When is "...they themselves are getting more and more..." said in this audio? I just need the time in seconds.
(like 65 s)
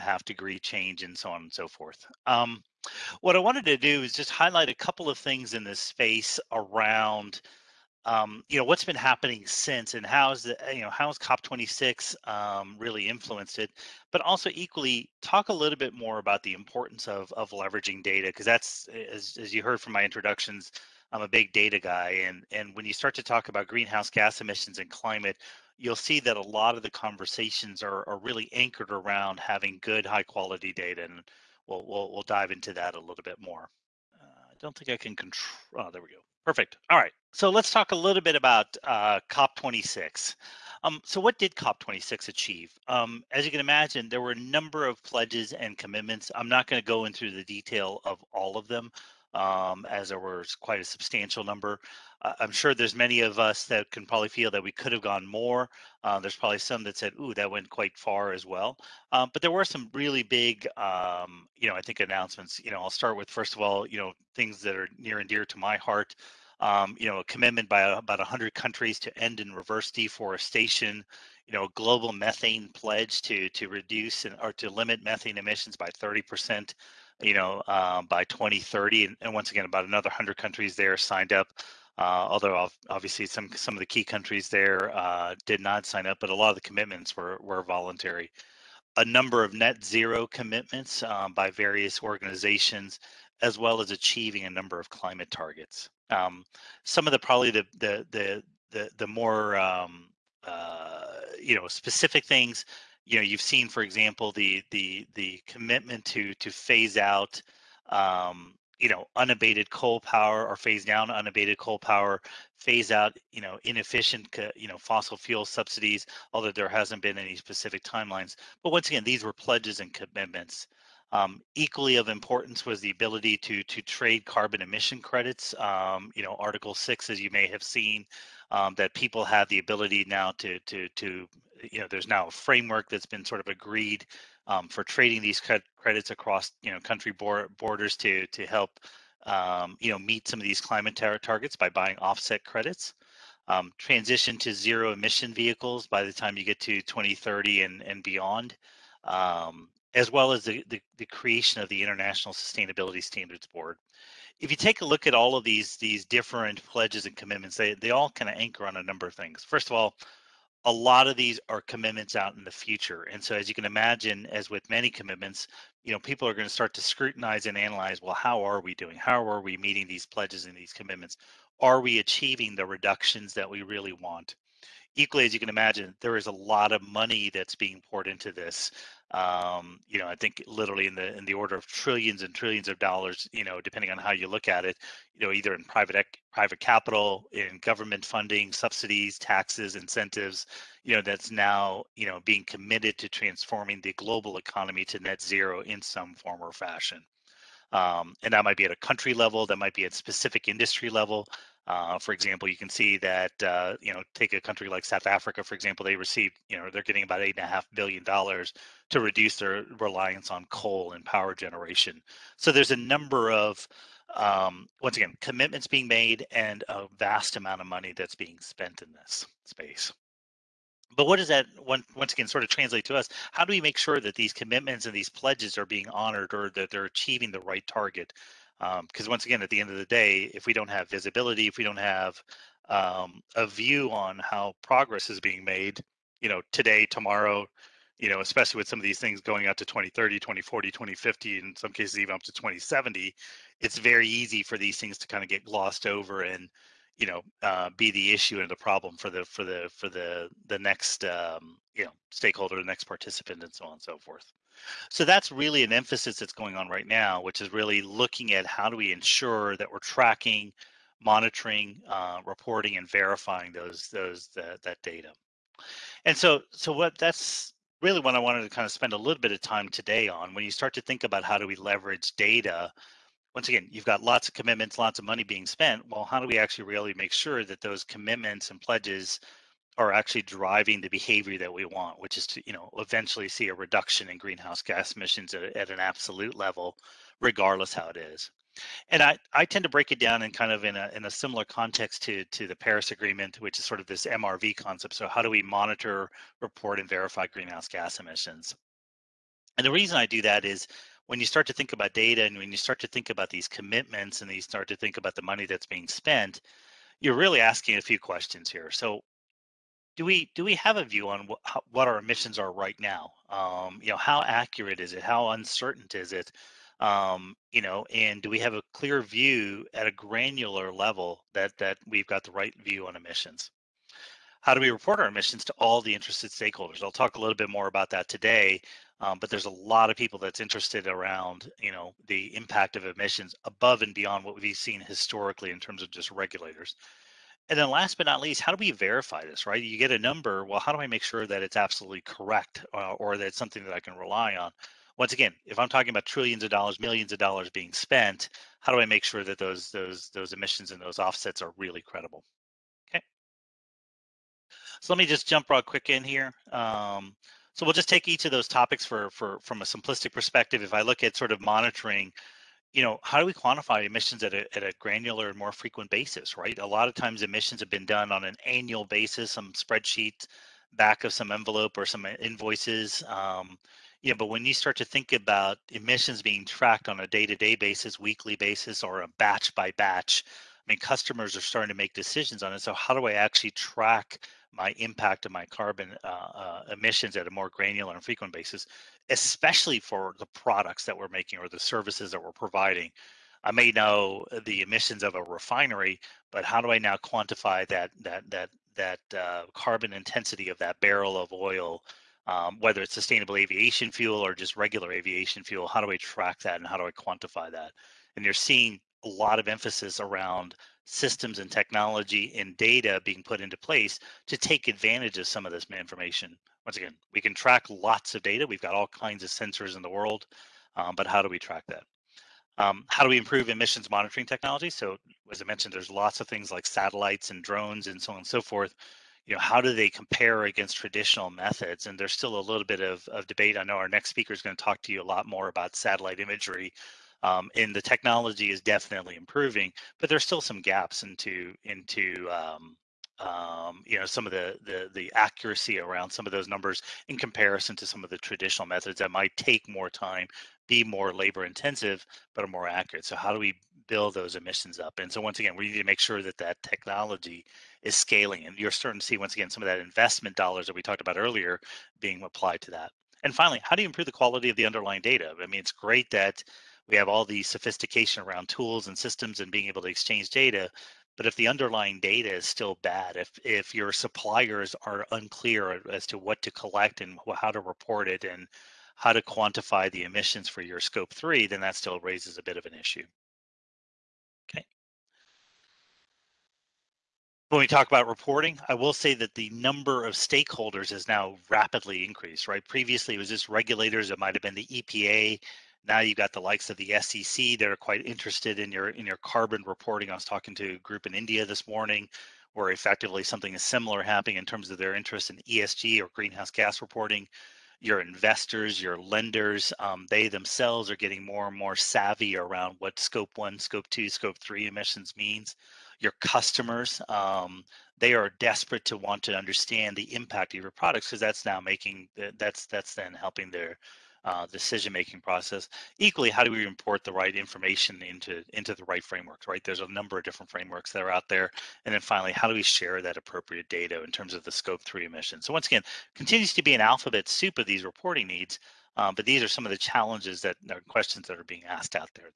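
510 s.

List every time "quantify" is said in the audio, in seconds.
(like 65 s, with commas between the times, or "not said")
363 s, 396 s, 406 s, 479 s.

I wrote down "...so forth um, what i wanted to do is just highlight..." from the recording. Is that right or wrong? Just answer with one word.
right.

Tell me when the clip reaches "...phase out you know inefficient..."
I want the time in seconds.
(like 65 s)
112 s.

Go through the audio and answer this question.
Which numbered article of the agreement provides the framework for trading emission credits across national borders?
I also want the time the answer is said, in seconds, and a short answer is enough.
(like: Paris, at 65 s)
Article Six, at 126 s.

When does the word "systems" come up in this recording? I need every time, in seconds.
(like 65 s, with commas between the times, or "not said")
410 s, 468 s.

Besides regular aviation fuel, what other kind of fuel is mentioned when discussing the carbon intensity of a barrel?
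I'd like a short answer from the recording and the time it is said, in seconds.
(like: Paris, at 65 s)
sustainable aviation fuel, at 402 s.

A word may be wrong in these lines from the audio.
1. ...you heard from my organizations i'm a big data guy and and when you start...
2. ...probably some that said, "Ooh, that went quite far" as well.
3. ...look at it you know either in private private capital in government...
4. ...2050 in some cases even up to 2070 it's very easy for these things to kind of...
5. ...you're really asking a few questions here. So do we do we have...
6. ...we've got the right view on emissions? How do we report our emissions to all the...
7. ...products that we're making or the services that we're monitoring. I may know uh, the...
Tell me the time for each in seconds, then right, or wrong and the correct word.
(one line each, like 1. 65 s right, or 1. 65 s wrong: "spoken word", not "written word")
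1. 19 s wrong: "introductions", not "organizations"
2. 56 s right
3. 184 s right
4. 240 s right
5. 306 s right
6. 321 s right
7. 390 s wrong: "providing", not "monitoring".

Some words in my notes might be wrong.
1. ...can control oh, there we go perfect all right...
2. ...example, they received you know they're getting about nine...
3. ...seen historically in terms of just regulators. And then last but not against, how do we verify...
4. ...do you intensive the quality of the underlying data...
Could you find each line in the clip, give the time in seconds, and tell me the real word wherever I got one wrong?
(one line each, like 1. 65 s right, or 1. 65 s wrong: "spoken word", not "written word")
1. 34 s right
2. 205 s wrong: "eight", not "nine"
3. 334 s wrong: "least", not "against"
4. 463 s wrong: "improve", not "intensive".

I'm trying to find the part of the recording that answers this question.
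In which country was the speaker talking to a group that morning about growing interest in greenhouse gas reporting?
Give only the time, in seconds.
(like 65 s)
501 s.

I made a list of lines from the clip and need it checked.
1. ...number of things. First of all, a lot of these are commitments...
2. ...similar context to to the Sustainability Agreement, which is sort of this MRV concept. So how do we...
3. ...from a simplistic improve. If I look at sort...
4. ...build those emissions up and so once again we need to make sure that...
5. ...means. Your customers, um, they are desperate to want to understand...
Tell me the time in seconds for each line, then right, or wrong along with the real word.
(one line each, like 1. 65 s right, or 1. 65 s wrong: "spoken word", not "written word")
1. 158 s right
2. 291 s wrong: "Paris", not "Sustainability"
3. 359 s wrong: "perspective", not "improve"
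4. 453 s right
5. 515 s right.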